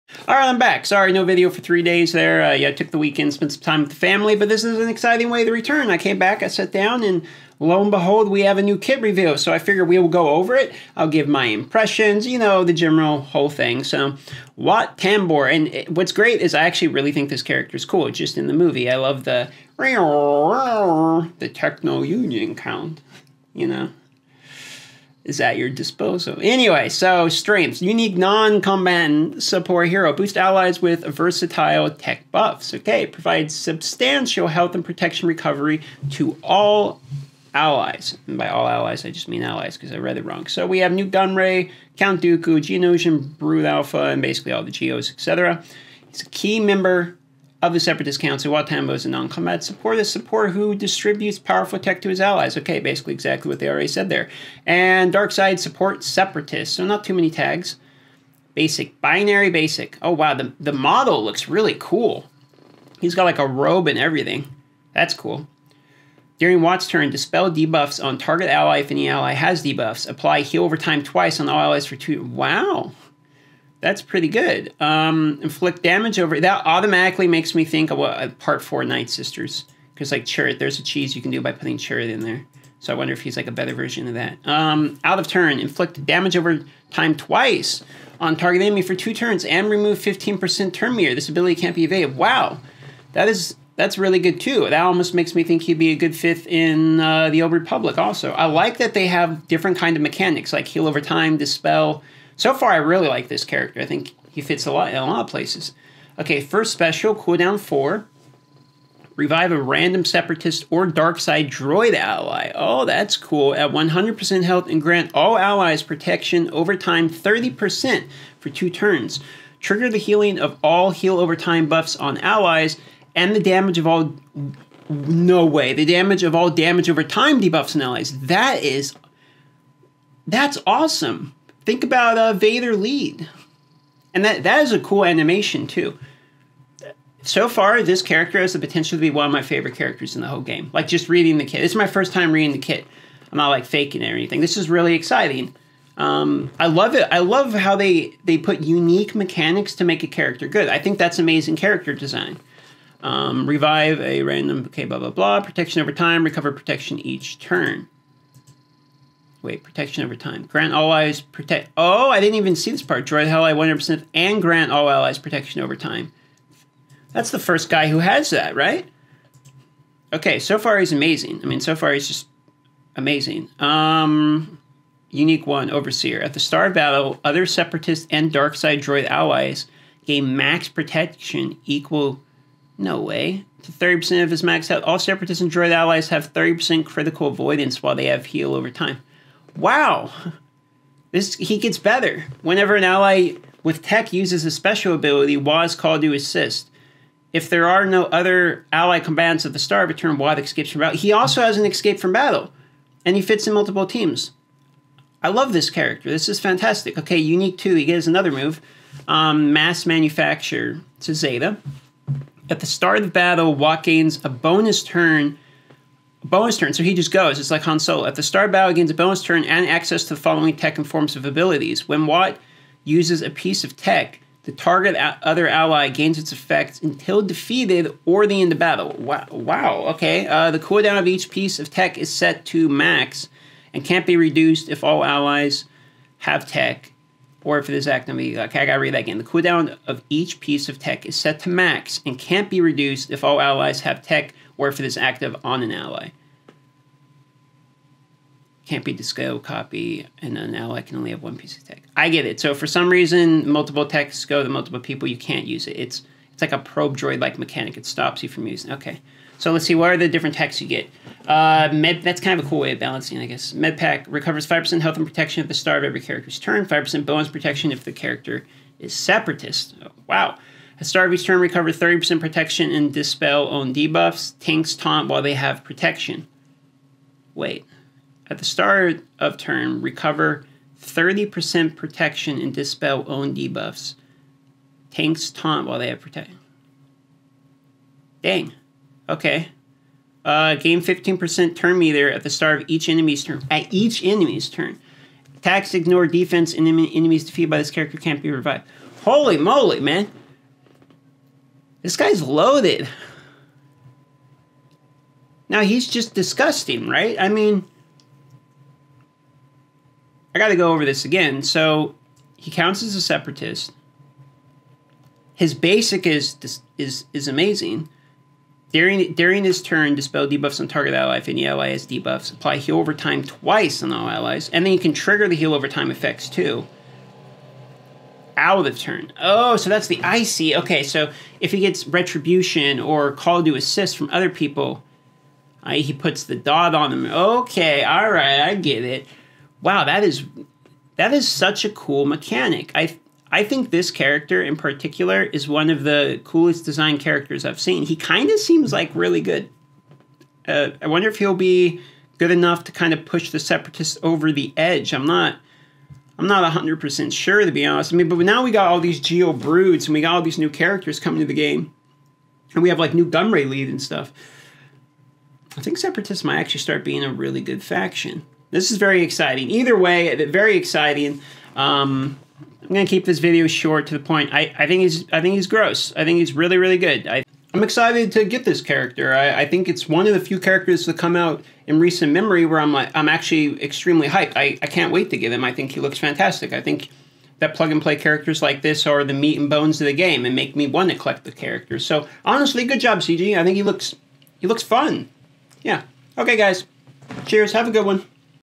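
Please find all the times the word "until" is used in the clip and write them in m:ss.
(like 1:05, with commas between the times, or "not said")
3:46.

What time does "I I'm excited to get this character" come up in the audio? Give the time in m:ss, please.
6:17.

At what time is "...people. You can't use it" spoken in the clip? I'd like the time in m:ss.
4:14.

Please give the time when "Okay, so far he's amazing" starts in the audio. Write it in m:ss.
2:50.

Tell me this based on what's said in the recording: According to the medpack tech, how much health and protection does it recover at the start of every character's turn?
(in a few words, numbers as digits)
5%.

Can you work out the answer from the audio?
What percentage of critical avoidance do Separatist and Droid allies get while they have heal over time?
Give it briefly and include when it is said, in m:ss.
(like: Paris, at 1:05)
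30%, at 3:06.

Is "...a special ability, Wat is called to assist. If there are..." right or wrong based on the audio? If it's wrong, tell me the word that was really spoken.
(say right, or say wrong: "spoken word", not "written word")
right.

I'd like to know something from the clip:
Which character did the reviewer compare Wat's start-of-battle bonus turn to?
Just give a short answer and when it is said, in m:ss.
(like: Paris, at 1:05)
Han Solo, at 3:37.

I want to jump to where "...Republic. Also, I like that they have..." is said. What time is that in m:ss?
1:37.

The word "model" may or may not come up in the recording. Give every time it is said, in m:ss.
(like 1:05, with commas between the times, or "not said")
1:00.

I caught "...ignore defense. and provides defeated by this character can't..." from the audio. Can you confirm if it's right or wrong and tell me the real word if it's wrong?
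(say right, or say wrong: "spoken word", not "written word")
wrong: "enemies", not "provides".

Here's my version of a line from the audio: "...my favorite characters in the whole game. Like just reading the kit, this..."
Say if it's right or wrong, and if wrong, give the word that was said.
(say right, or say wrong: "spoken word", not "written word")
right.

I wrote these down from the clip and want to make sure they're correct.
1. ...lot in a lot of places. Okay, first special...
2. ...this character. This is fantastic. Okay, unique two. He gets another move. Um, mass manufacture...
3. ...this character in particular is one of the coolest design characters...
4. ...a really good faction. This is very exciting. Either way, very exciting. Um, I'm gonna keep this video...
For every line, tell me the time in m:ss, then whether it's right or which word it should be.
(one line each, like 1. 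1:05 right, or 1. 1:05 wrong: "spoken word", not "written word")
1. 1:44 right
2. 3:25 right
3. 5:43 right
4. 6:07 right.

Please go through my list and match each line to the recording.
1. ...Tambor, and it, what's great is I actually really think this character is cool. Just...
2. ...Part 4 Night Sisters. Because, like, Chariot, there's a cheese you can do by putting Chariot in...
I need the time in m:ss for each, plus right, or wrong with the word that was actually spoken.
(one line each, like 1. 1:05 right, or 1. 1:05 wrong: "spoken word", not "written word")
1. 0:14 right
2. 1:18 right.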